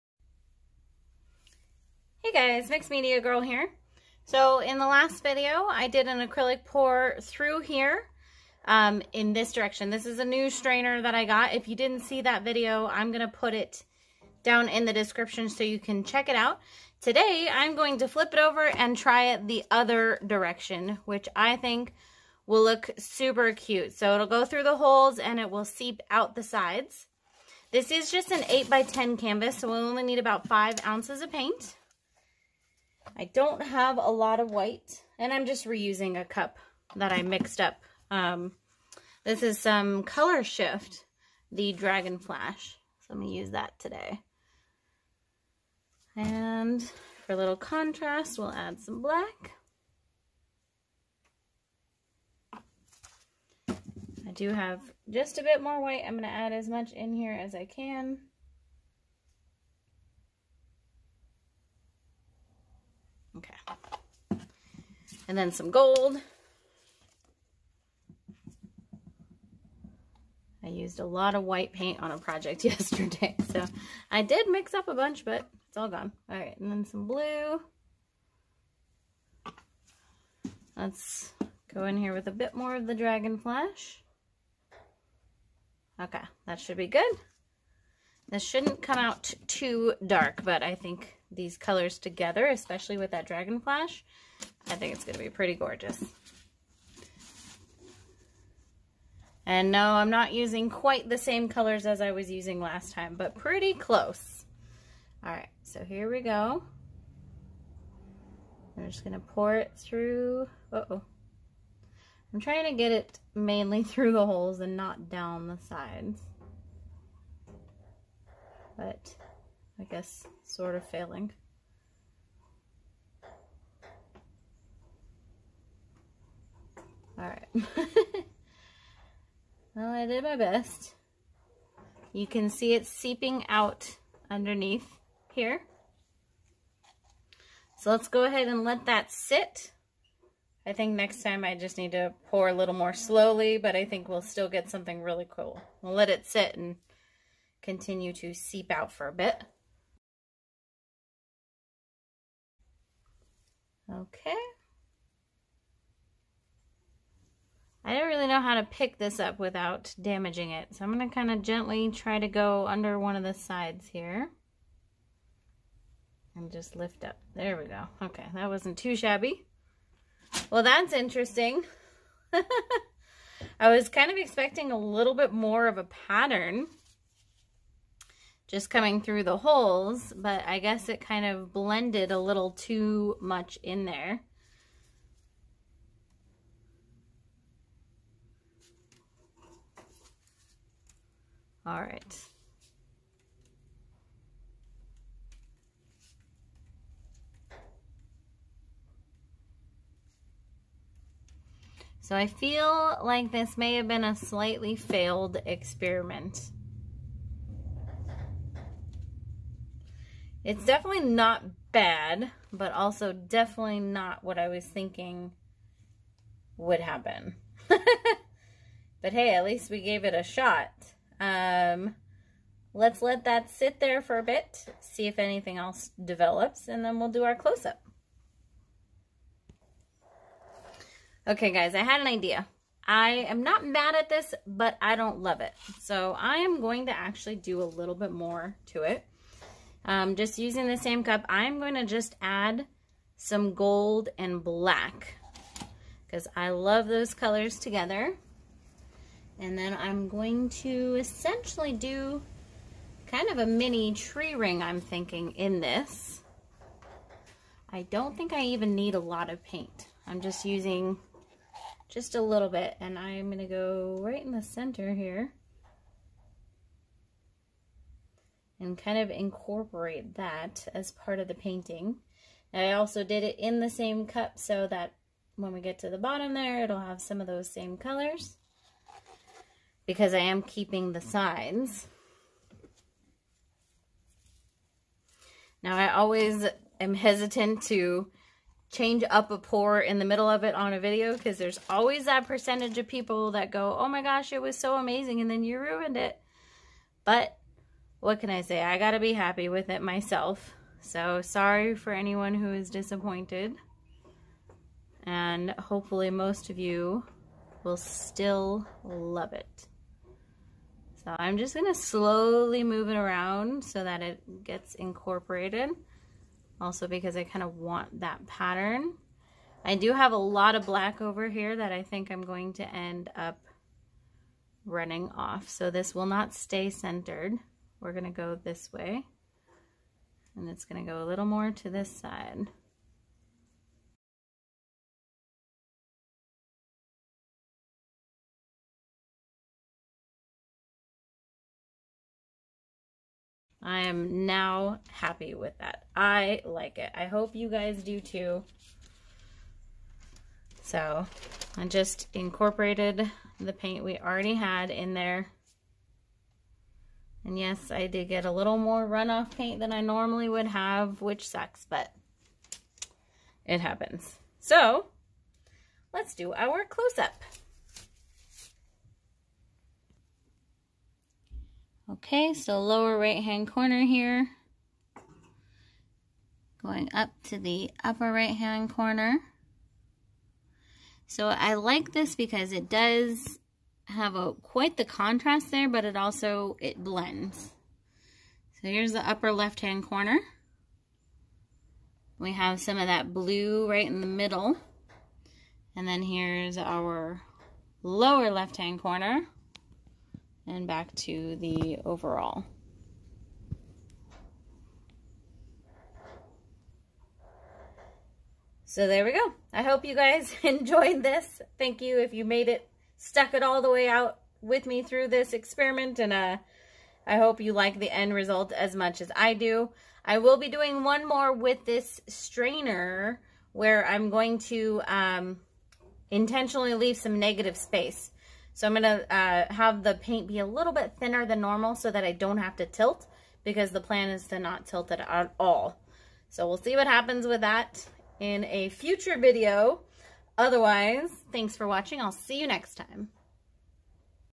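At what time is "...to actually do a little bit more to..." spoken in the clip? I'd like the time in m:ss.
3:56.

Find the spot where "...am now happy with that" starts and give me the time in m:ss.
5:43.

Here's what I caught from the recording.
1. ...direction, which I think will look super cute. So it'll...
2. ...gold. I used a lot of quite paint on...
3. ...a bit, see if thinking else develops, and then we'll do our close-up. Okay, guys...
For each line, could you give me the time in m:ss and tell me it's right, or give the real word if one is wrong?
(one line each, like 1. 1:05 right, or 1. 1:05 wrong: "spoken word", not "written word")
1. 0:20 right
2. 1:05 wrong: "white", not "quite"
3. 3:44 wrong: "anything", not "thinking".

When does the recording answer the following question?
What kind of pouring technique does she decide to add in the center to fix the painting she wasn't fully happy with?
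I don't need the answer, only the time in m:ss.
4:13.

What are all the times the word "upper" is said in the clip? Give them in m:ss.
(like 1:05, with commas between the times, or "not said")
6:17, 6:29.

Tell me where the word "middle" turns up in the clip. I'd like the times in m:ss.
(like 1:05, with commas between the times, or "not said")
4:50, 6:34.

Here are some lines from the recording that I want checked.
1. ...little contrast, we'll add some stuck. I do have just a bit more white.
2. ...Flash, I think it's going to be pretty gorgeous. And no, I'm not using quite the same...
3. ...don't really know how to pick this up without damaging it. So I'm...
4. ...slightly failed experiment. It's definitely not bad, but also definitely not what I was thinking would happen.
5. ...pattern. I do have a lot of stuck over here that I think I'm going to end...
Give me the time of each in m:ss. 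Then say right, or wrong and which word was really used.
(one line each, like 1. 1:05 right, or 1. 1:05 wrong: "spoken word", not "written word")
1. 0:47 wrong: "black", not "stuck"
2. 1:33 right
3. 2:37 right
4. 3:24 right
5. 5:18 wrong: "black", not "stuck".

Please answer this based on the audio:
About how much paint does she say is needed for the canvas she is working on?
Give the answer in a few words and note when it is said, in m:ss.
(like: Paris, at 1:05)
5 ounces, at 0:30.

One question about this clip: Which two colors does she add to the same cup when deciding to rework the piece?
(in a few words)
Gold and black.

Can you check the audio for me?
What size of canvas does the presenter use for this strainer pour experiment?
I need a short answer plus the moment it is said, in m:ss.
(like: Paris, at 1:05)
8 by 10, at 0:28.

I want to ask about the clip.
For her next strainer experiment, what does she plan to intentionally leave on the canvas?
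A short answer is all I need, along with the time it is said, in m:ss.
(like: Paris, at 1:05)
Negative space, at 7:07.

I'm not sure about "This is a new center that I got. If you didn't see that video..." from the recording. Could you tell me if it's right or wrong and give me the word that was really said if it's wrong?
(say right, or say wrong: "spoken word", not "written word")
wrong: "strainer", not "center".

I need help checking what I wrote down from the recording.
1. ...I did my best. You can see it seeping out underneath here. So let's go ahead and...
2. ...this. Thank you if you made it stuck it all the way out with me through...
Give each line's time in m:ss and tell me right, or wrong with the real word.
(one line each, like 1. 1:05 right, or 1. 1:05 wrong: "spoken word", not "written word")
1. 2:09 right
2. 6:51 right.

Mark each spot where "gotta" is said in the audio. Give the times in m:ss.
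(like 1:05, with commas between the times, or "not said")
4:58.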